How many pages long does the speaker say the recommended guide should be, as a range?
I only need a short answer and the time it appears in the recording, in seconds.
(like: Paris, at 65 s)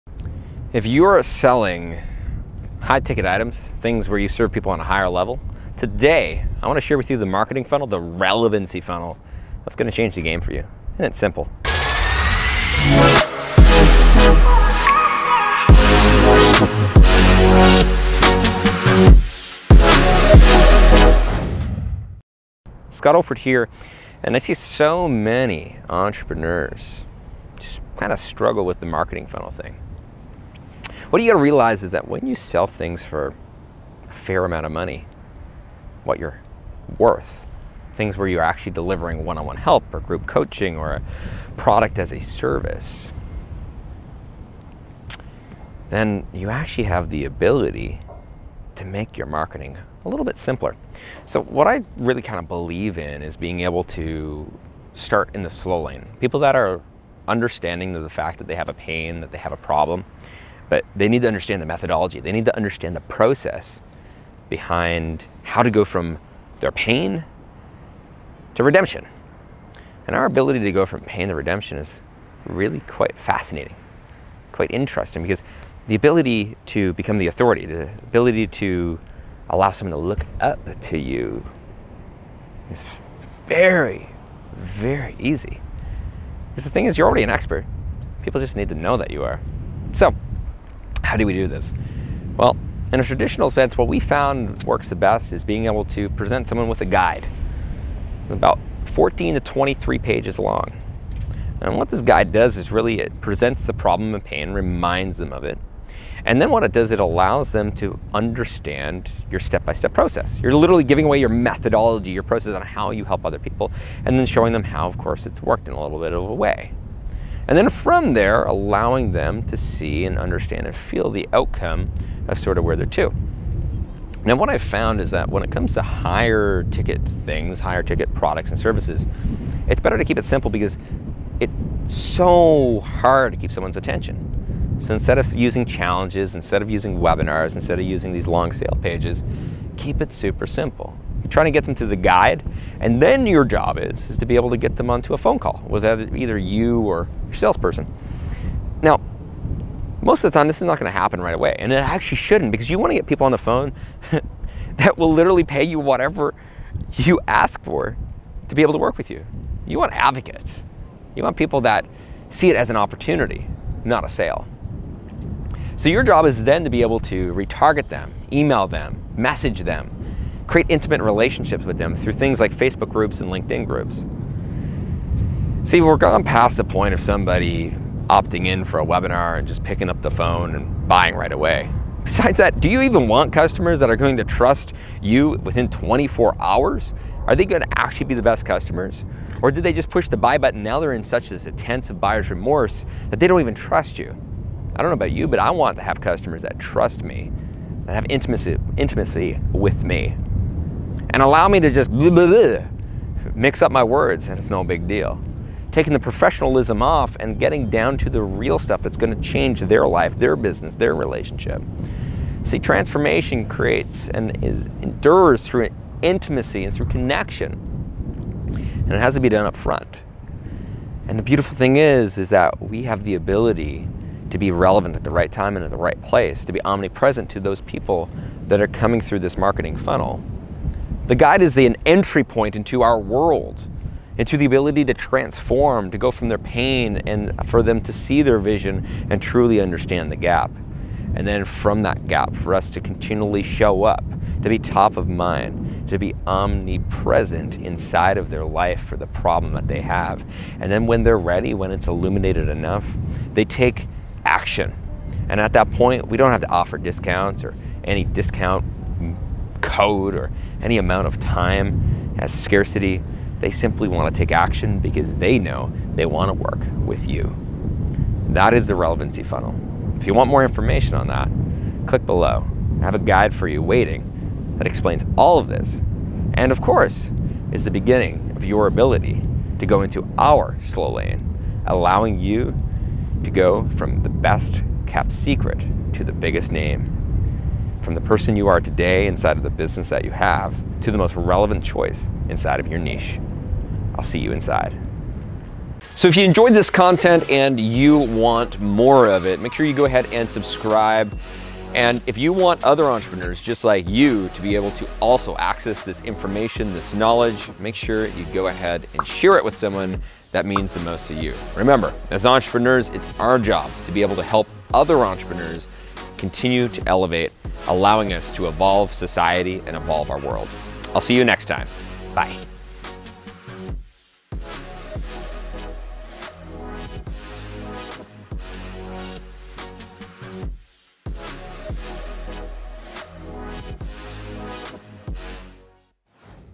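14 to 23, at 98 s.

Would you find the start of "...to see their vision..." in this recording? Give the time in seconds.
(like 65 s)
237 s.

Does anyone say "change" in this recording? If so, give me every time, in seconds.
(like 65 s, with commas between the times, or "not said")
9 s, 209 s.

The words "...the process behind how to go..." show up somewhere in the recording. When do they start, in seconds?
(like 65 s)
62 s.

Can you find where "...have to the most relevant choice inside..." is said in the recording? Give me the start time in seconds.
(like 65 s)
290 s.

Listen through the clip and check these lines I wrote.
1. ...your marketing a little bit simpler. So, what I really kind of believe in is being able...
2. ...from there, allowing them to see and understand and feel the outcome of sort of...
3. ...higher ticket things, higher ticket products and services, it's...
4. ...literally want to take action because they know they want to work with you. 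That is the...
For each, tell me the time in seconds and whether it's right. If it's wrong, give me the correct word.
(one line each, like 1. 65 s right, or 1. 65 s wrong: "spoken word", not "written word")
1. 49 s right
2. 117 s right
3. 125 s right
4. 263 s wrong: "simply", not "literally".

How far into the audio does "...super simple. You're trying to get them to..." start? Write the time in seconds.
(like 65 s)
140 s.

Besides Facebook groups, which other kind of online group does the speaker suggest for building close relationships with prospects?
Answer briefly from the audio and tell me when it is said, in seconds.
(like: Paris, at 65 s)
LinkedIn groups, at 173 s.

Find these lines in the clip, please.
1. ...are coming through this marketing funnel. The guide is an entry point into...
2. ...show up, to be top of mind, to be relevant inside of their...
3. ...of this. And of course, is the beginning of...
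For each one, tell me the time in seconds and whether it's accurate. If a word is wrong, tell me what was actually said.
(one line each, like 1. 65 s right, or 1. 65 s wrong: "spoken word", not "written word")
1. 228 s right
2. 243 s wrong: "omnipresent", not "relevant"
3. 275 s right.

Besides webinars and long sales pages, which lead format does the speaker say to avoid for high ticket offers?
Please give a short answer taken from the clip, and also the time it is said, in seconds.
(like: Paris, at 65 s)
challenges, at 135 s.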